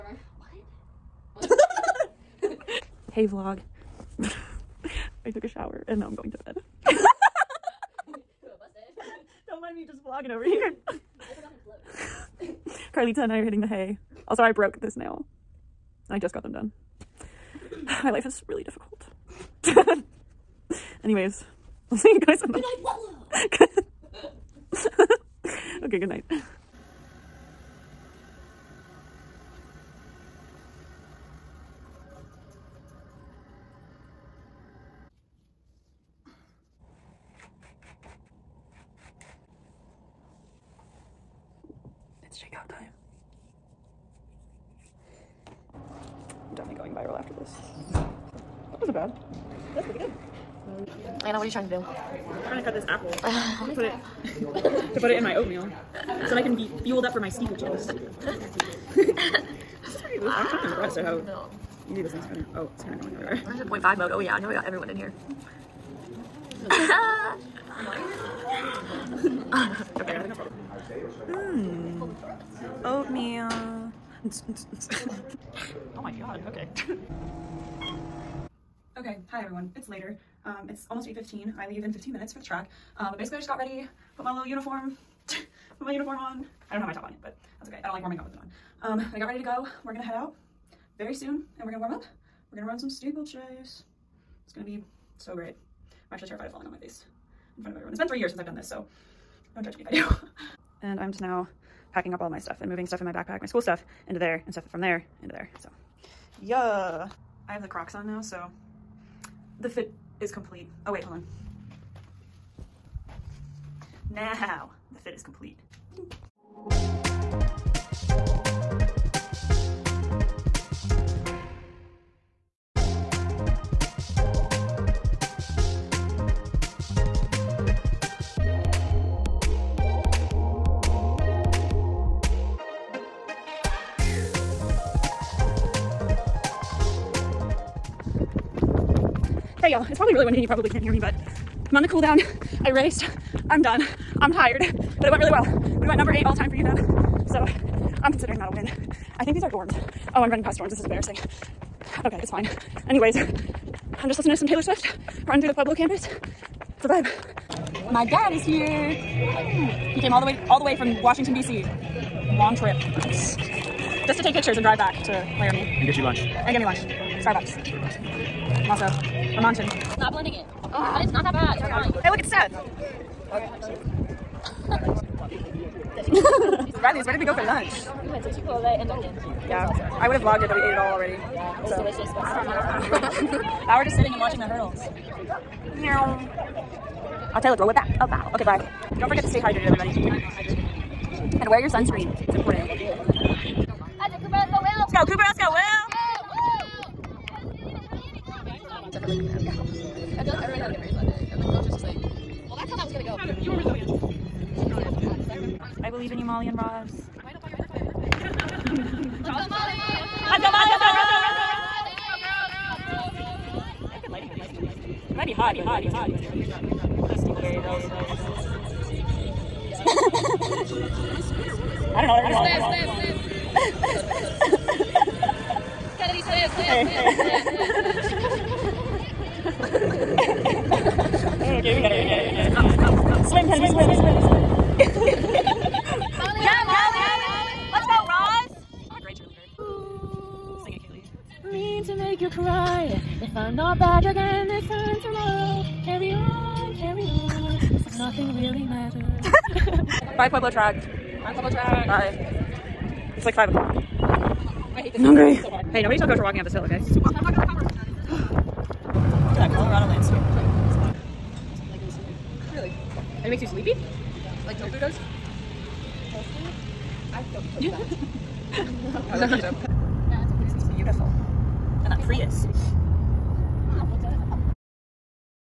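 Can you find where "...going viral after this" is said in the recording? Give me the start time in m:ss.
0:46.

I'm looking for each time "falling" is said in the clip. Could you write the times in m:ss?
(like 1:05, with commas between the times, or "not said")
1:36.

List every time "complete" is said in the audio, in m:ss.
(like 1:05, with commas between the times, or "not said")
1:50, 1:55.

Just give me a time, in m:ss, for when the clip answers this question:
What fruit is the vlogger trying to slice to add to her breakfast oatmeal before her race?
0:52.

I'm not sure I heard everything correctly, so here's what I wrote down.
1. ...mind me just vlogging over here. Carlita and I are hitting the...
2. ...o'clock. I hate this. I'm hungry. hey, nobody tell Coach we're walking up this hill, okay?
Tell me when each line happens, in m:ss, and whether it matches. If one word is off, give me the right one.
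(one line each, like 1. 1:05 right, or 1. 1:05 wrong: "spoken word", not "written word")
1. 0:09 right
2. 4:13 right.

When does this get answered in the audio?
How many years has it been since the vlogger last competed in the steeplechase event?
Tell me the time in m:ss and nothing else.
1:38.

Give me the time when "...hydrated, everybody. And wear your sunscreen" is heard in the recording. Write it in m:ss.
3:09.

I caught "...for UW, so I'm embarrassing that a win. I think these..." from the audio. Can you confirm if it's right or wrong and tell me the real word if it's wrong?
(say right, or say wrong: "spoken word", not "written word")
wrong: "considering", not "embarrassing".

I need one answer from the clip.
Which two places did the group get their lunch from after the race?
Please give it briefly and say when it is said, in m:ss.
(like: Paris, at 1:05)
Chipotle and Dunkin', at 2:58.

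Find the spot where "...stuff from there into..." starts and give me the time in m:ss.
1:44.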